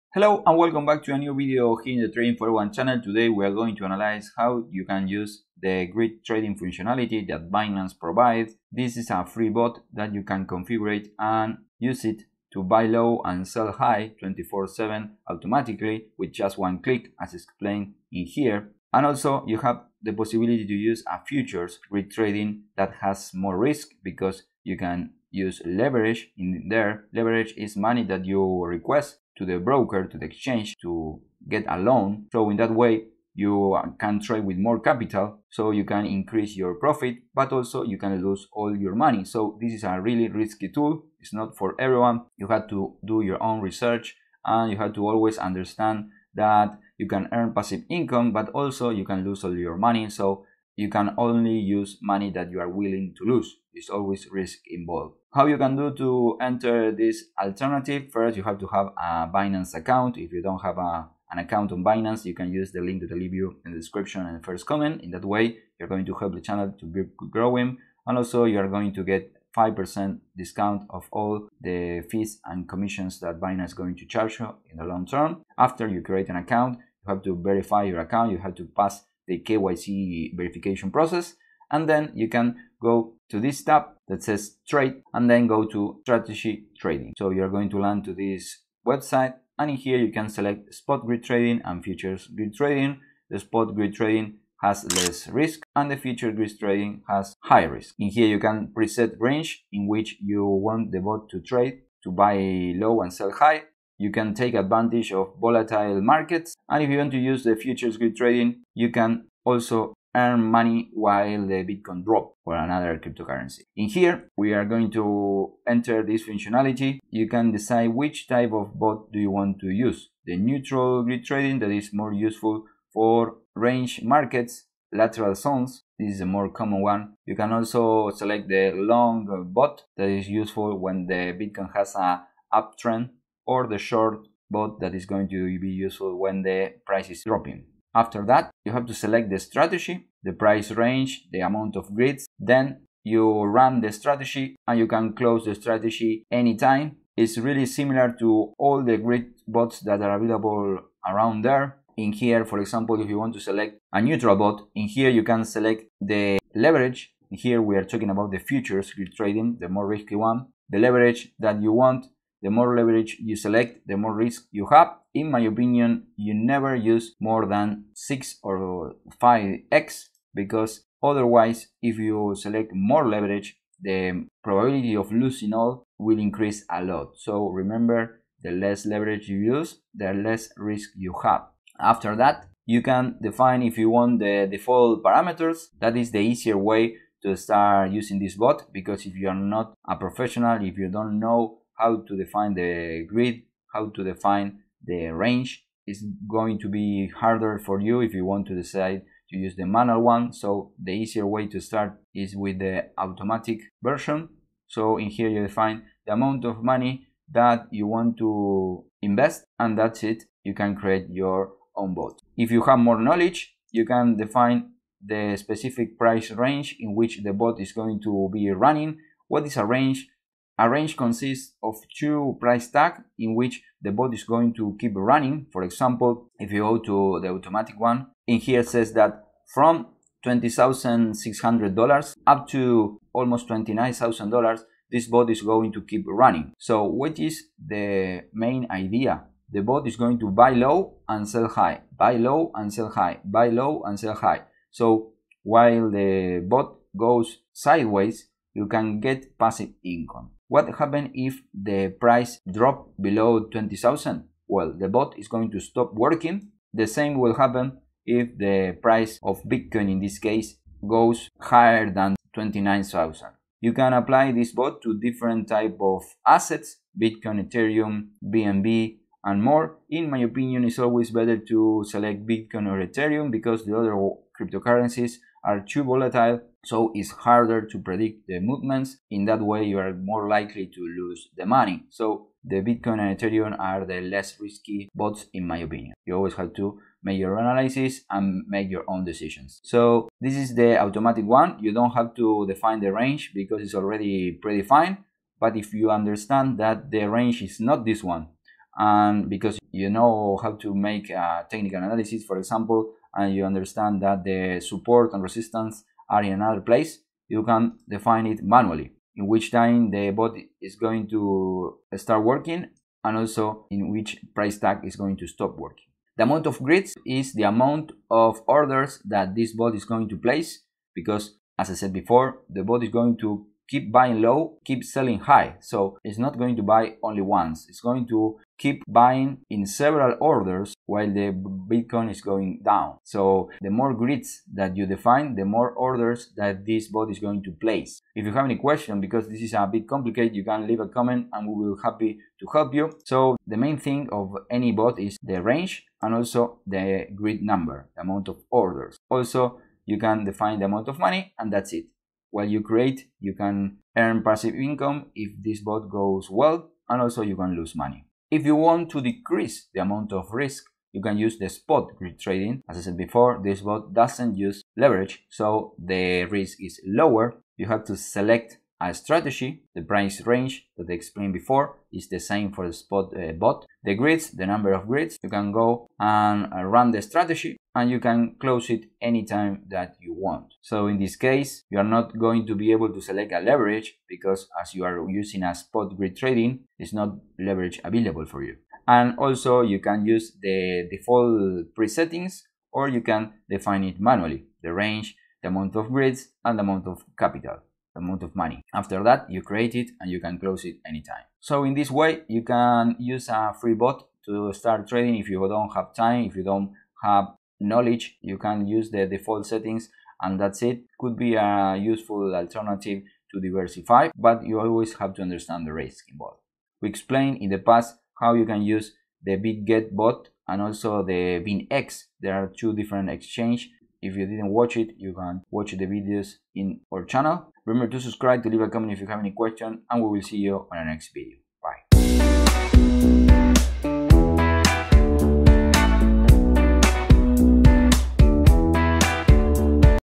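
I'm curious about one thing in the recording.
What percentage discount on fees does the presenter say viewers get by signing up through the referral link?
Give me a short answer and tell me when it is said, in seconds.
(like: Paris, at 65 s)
5%, at 69 s.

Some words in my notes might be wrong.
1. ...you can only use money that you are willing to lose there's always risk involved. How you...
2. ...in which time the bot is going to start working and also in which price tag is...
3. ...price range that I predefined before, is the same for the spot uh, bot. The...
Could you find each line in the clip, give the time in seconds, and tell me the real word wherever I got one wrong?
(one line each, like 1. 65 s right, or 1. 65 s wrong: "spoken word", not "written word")
1. 50 s right
2. 309 s right
3. 369 s wrong: "explained", not "predefined".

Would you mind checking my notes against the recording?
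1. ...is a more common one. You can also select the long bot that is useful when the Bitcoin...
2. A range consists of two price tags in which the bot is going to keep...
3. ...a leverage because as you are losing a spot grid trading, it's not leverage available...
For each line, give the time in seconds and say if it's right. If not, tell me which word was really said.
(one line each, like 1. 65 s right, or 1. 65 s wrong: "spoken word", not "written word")
1. 126 s right
2. 220 s right
3. 383 s wrong: "using", not "losing".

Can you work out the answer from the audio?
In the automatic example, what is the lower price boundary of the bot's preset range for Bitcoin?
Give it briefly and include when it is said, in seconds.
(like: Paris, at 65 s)
$20,600, at 230 s.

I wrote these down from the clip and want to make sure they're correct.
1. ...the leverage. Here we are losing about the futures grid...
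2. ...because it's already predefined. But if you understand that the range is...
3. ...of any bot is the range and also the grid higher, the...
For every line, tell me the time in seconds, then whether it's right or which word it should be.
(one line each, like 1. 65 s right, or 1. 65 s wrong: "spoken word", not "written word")
1. 155 s wrong: "talking", not "losing"
2. 293 s right
3. 344 s wrong: "number", not "higher".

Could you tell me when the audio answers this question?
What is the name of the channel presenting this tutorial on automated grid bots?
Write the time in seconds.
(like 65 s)
2 s.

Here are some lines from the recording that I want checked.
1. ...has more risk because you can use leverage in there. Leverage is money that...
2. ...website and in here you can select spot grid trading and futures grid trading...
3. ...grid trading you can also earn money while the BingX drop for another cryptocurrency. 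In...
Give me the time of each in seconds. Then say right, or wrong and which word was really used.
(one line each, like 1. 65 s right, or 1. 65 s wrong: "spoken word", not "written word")
1. 22 s right
2. 88 s right
3. 107 s wrong: "Bitcoin", not "BingX".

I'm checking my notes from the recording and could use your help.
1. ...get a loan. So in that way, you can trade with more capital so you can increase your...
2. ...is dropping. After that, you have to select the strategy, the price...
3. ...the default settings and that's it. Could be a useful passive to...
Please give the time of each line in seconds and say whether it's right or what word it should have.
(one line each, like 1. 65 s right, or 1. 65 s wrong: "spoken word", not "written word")
1. 31 s right
2. 137 s right
3. 408 s wrong: "alternative", not "passive".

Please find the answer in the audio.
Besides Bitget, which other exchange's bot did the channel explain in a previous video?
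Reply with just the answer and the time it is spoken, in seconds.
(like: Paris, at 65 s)
BingX, at 421 s.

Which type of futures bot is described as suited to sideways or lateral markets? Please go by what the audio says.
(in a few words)
Neutral grid trading.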